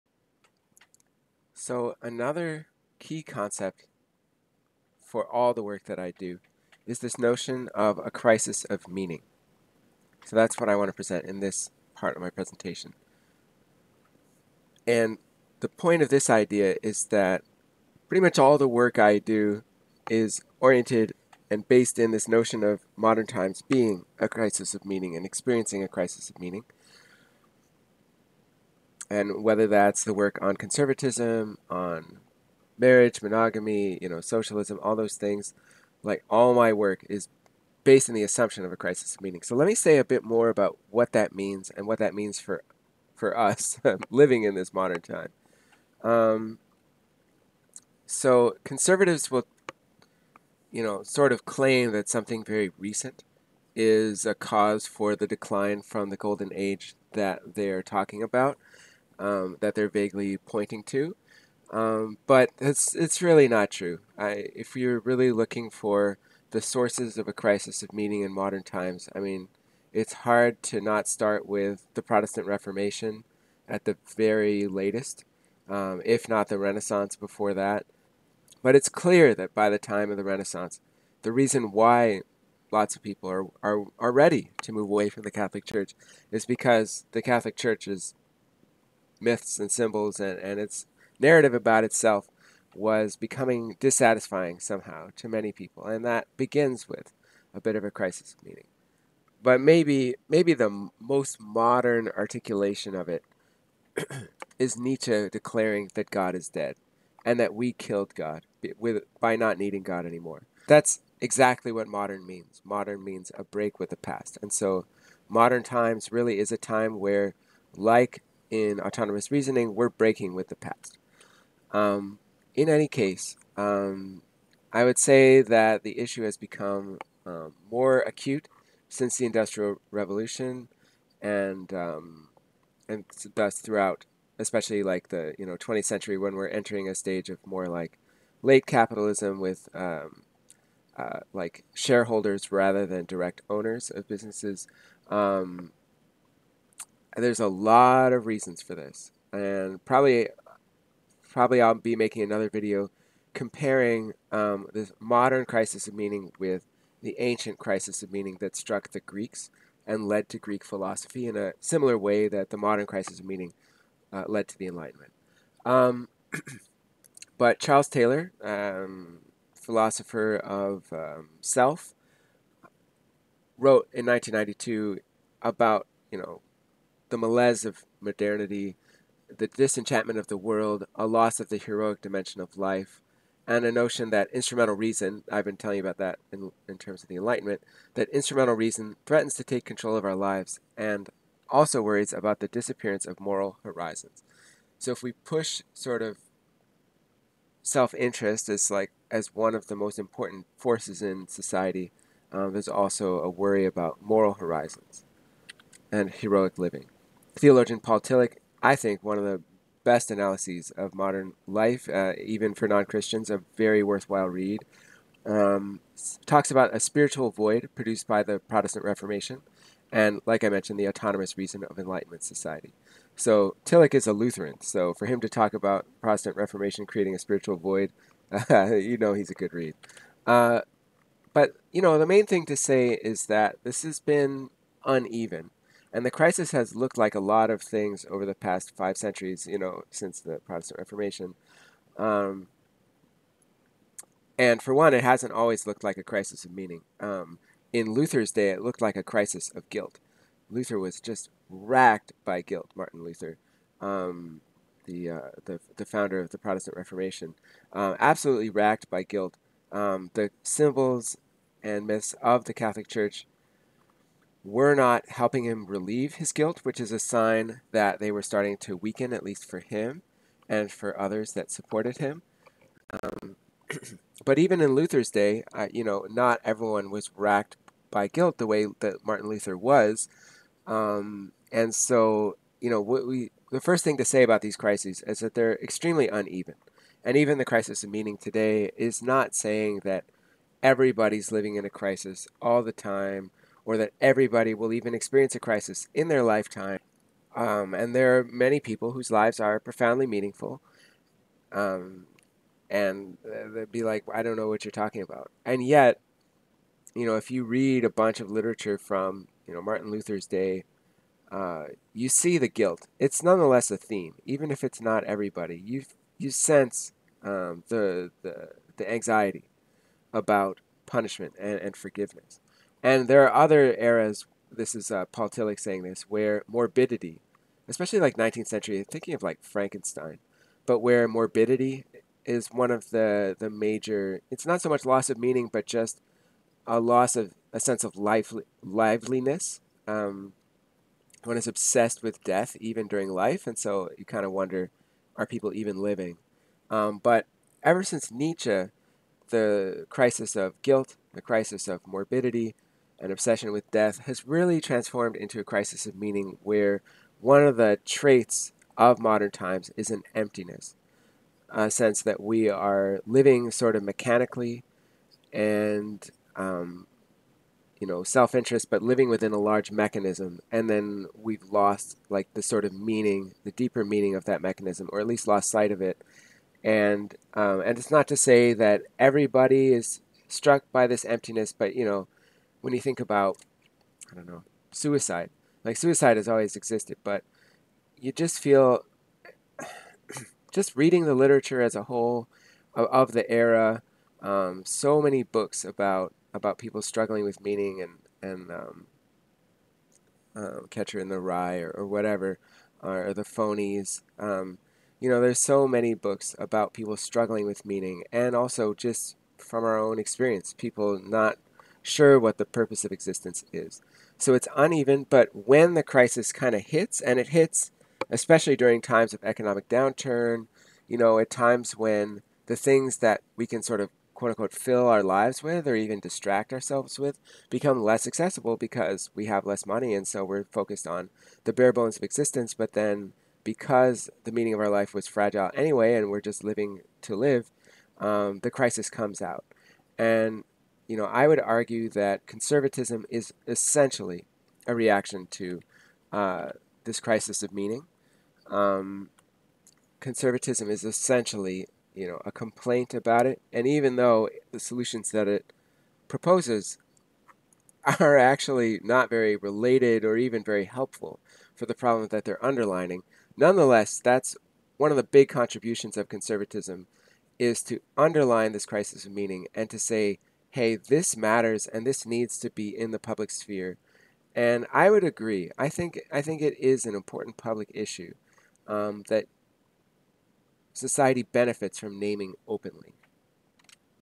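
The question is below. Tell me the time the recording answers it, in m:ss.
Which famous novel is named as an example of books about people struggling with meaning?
6:40.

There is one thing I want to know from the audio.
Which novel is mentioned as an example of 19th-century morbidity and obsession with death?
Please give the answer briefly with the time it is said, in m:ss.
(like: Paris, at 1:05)
Frankenstein, at 5:29.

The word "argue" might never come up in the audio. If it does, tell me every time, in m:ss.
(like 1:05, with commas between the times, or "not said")
7:21.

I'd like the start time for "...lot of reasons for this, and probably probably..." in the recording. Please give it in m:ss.
2:27.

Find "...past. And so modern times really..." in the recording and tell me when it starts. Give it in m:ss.
1:53.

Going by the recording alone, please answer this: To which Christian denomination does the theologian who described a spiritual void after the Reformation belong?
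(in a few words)
Lutheran.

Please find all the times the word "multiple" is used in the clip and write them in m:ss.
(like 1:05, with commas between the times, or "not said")
not said.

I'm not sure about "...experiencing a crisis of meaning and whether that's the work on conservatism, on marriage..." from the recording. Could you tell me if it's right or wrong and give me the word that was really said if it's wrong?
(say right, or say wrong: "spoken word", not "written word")
right.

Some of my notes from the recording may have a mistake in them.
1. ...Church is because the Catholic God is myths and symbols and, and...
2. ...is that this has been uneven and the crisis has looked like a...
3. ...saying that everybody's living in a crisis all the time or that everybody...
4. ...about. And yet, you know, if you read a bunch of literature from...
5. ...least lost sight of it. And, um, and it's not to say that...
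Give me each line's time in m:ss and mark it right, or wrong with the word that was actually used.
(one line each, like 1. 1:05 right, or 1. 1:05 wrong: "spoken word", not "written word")
1. 1:25 wrong: "Church", not "God"
2. 3:53 right
3. 4:49 right
4. 5:05 right
5. 6:15 right.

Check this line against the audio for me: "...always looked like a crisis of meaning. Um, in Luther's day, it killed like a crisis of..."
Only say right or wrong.
wrong.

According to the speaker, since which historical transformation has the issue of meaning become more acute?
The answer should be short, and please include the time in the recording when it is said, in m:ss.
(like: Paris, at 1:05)
Industrial Revolution, at 2:09.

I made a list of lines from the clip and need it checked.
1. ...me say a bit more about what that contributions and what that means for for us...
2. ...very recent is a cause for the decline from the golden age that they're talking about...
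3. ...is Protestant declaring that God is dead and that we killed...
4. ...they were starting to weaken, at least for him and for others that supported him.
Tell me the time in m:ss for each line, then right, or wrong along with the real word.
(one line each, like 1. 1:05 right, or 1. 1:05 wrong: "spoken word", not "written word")
1. 0:39 wrong: "means", not "contributions"
2. 0:52 right
3. 1:44 wrong: "Nietzsche", not "Protestant"
4. 4:27 right.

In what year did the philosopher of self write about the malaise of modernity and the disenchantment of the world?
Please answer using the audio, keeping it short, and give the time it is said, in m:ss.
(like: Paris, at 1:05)
1992, at 2:54.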